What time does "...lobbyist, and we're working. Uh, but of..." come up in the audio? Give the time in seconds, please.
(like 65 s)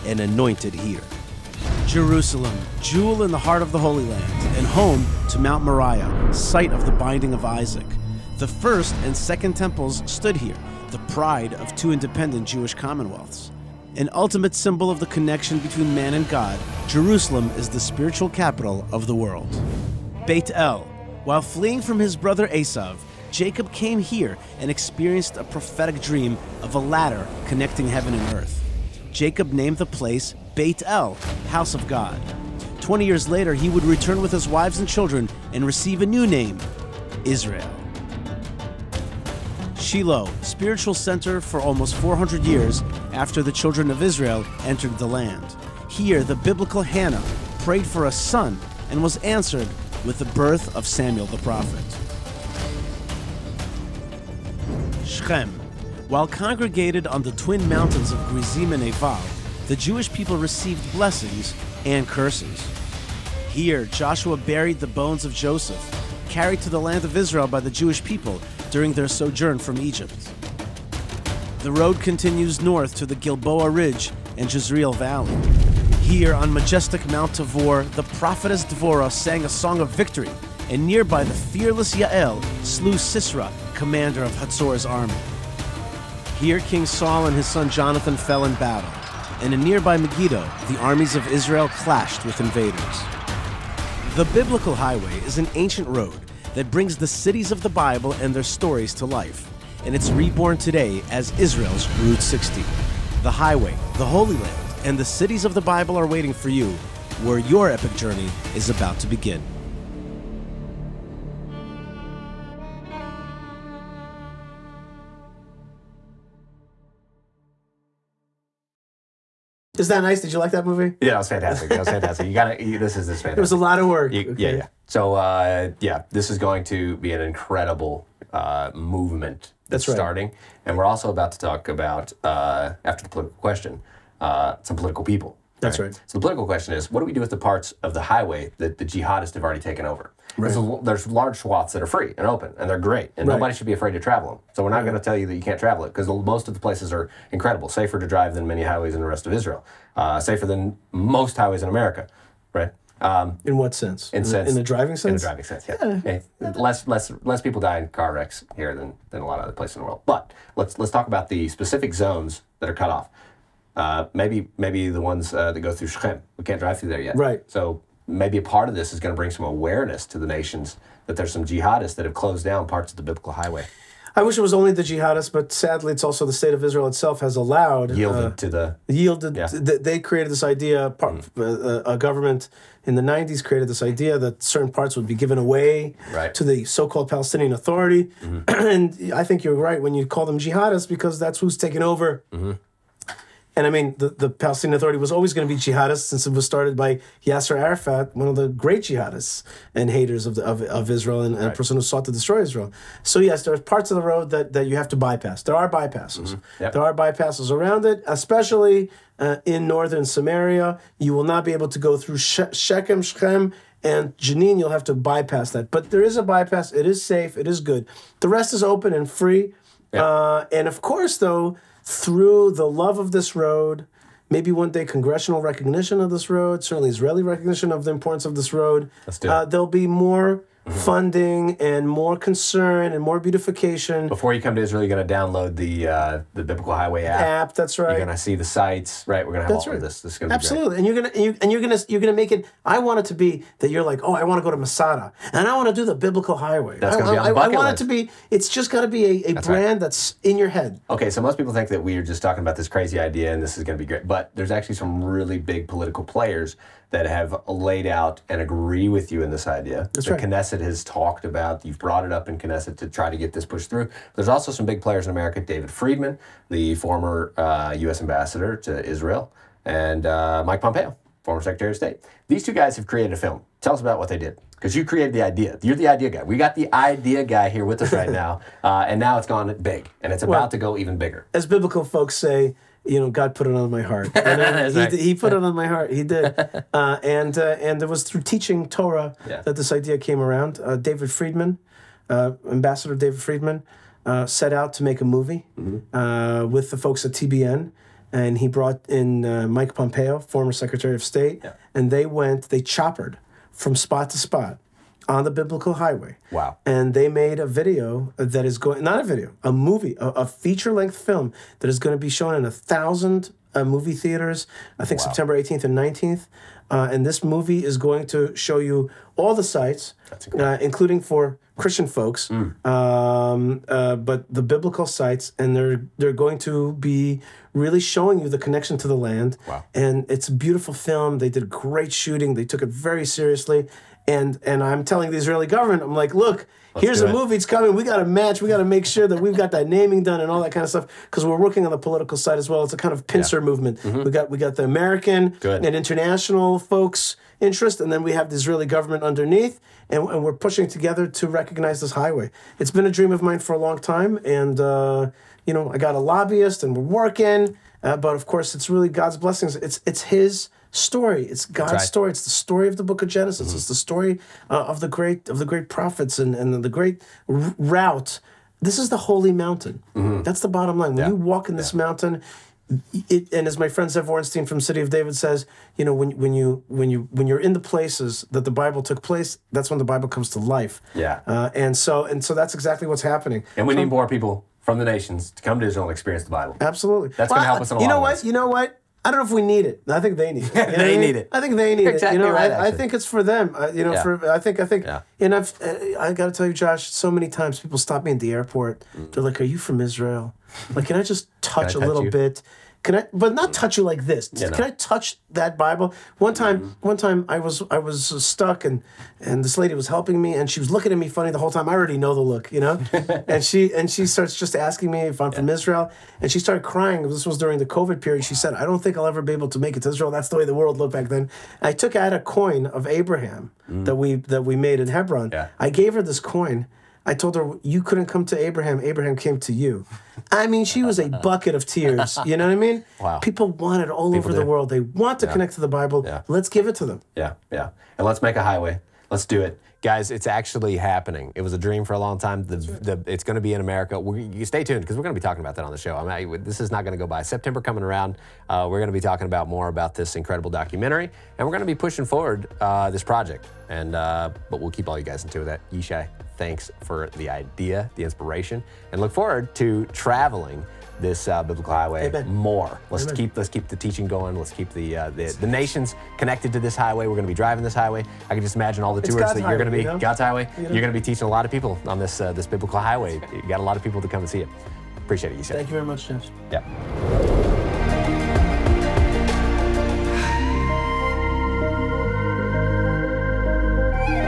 356 s.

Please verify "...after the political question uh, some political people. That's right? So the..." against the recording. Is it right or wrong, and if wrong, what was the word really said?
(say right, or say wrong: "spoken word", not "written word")
right.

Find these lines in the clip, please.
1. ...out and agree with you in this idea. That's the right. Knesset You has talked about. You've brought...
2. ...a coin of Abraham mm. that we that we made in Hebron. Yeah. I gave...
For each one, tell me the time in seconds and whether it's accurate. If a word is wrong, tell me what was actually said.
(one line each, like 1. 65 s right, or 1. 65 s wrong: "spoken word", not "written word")
1. 257 s wrong: "Knesset", not "You"
2. 422 s right.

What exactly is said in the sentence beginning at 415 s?
from Israel and she started crying.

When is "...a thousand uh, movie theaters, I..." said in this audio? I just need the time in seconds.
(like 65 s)
312 s.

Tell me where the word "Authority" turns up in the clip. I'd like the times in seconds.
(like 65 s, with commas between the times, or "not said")
187 s, 194 s.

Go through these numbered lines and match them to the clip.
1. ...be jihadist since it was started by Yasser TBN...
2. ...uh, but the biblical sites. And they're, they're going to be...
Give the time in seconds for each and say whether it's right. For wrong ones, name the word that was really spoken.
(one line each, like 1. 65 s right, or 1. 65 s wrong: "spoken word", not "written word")
1. 195 s wrong: "Arafat", not "TBN"
2. 323 s right.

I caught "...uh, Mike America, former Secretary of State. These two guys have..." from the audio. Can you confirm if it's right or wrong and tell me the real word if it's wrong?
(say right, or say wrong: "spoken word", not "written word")
wrong: "Pompeo", not "America".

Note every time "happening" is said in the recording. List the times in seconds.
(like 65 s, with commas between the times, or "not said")
383 s, 440 s.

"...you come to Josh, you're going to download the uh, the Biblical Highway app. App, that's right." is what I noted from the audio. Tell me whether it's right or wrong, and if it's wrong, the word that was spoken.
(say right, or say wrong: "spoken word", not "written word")
wrong: "Israel", not "Josh".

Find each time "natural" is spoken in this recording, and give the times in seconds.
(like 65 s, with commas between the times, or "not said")
not said.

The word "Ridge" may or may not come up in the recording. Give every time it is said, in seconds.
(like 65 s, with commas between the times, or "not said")
73 s.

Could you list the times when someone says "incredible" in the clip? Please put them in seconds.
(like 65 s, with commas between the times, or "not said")
127 s, 147 s, 450 s.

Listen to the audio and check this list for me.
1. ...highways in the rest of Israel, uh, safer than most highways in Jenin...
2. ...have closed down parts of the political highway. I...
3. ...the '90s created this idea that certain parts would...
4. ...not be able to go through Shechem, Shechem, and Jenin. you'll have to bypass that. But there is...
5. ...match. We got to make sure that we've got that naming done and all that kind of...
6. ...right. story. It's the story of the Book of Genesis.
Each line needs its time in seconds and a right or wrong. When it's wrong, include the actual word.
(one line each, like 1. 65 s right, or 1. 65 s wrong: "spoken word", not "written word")
1. 148 s wrong: "America", not "Jenin"
2. 172 s wrong: "biblical", not "political"
3. 182 s right
4. 211 s right
5. 338 s right
6. 361 s right.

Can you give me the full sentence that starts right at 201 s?
a person who sought to destroy Israel.